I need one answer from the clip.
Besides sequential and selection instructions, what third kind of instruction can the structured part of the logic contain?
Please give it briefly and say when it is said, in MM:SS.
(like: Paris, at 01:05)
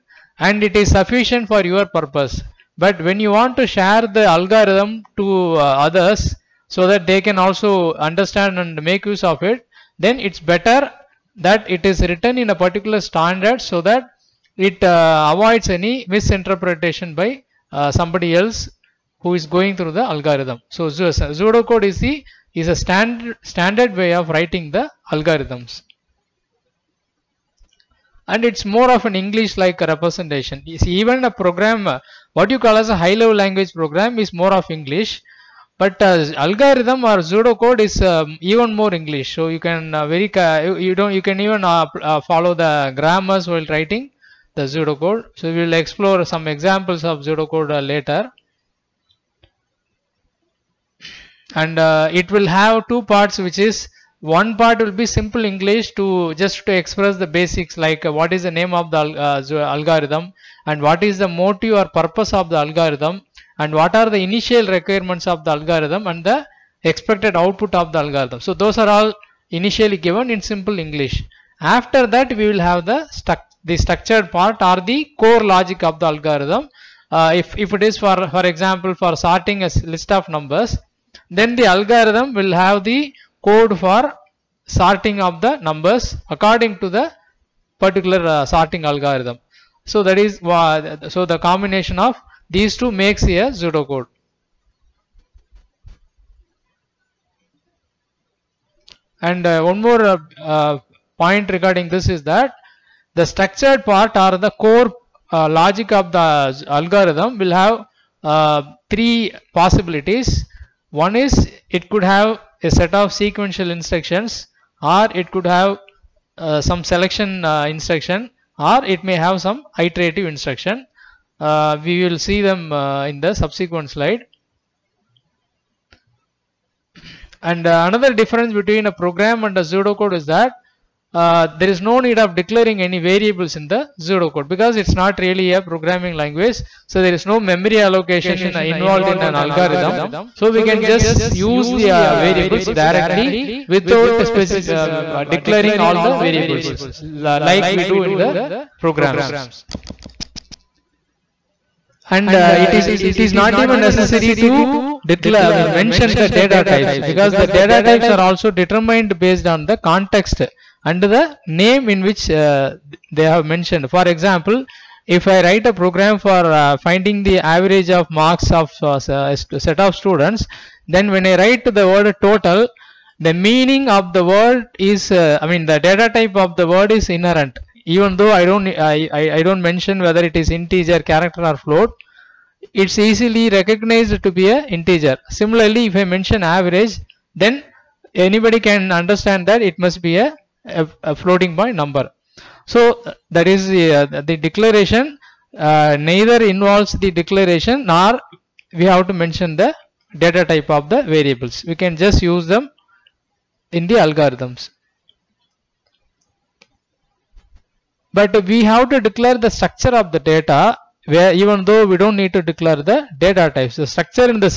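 Iterative, at 01:59.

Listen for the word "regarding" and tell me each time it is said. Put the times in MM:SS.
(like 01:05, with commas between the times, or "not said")
01:41.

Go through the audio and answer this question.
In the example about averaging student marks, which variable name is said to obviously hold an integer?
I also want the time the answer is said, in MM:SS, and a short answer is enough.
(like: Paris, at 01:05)
Total, at 02:52.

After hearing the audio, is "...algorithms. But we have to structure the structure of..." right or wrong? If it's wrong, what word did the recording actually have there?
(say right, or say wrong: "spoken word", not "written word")
wrong: "declare", not "structure".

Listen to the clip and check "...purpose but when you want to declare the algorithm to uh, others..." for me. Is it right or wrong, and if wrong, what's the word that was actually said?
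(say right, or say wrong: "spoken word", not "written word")
wrong: "share", not "declare".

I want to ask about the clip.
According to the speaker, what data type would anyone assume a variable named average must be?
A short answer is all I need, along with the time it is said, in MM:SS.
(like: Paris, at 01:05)
Floating point number, at 03:11.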